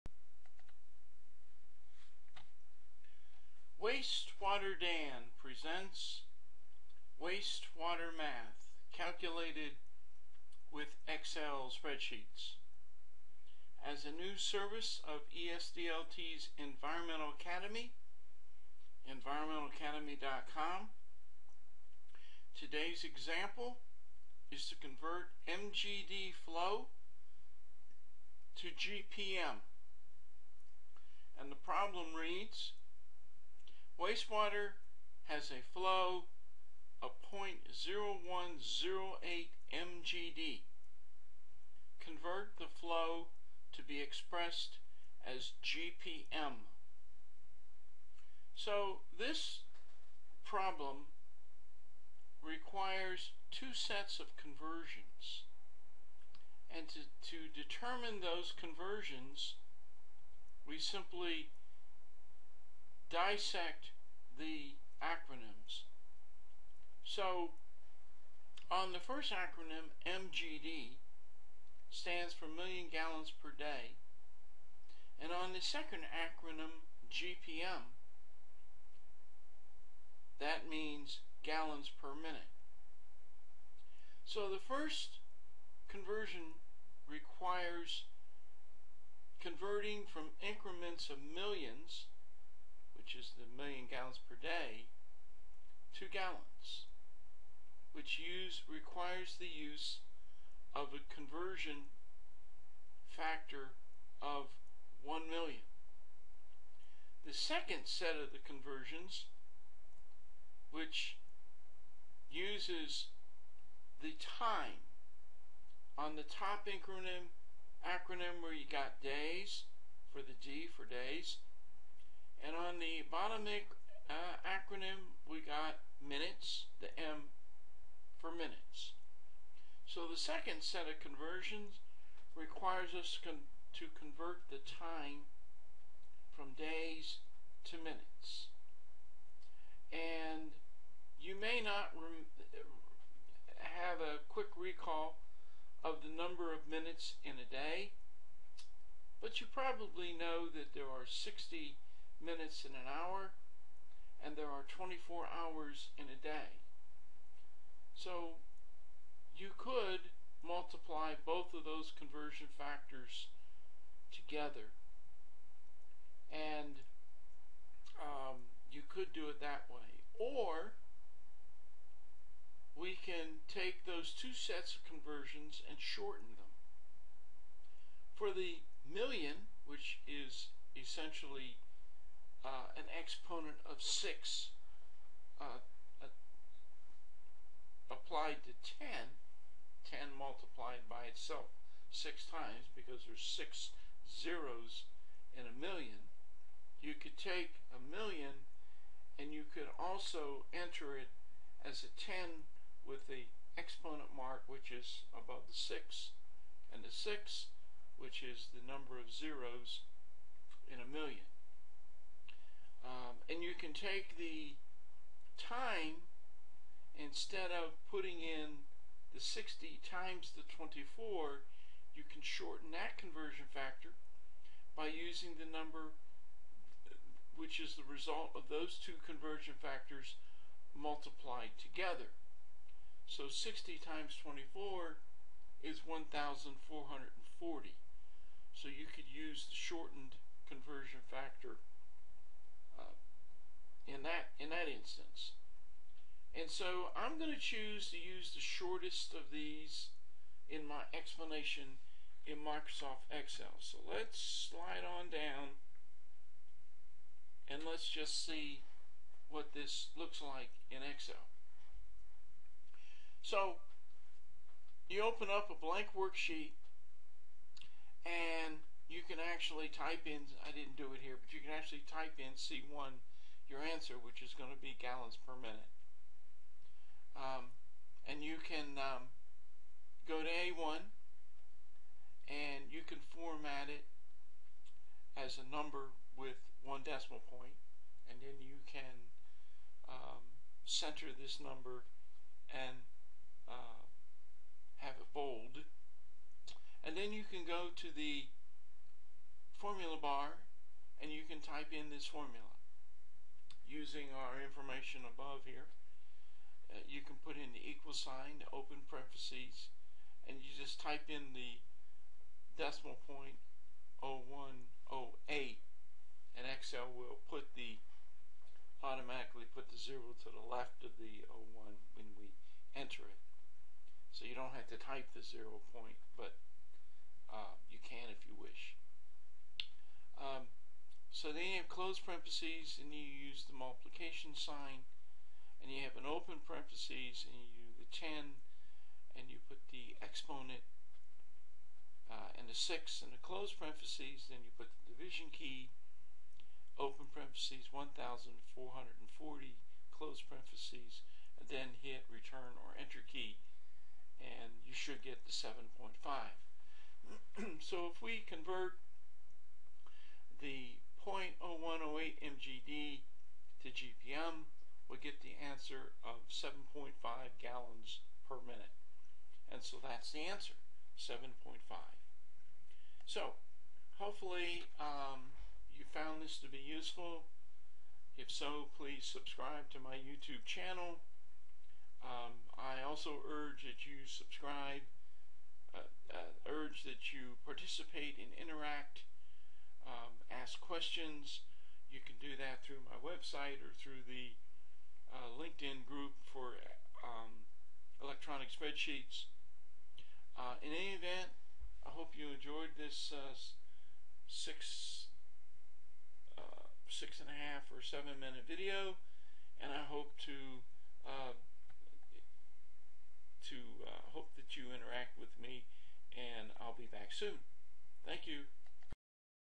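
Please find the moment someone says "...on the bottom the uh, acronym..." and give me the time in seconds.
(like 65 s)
122 s.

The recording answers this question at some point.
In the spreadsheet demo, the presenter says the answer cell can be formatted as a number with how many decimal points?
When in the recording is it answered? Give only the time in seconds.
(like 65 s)
286 s.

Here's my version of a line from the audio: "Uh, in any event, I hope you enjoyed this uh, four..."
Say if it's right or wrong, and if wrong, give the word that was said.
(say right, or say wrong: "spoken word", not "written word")
wrong: "six", not "four".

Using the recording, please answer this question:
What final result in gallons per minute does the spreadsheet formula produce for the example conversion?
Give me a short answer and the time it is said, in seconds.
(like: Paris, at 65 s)
7.5, at 366 s.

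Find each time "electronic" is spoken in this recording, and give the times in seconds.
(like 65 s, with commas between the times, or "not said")
398 s.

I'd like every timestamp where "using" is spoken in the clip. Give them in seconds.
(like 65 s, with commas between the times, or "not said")
224 s, 303 s.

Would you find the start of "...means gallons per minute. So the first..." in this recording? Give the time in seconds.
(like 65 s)
80 s.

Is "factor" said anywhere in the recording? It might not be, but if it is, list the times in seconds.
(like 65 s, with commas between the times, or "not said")
103 s, 162 s, 223 s, 229 s, 241 s.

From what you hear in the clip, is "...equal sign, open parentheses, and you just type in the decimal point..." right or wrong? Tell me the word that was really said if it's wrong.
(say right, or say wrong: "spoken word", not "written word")
right.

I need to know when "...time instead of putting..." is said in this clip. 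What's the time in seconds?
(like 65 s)
215 s.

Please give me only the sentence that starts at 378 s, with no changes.
If so, please subscribe to my YouTube channel.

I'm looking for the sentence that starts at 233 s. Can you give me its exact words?
So 60 times 24 is 1,440.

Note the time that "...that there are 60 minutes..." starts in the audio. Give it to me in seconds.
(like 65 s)
150 s.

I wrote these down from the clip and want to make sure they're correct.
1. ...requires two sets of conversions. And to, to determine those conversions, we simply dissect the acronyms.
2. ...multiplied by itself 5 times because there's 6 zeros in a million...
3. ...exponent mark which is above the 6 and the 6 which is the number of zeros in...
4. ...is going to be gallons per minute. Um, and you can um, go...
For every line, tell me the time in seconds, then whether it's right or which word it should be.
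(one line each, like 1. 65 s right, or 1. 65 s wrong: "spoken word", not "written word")
1. 52 s right
2. 190 s wrong: "6", not "5"
3. 203 s right
4. 274 s right.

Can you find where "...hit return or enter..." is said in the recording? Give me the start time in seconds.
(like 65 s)
351 s.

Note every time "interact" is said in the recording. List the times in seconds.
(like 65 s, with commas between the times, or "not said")
388 s, 414 s.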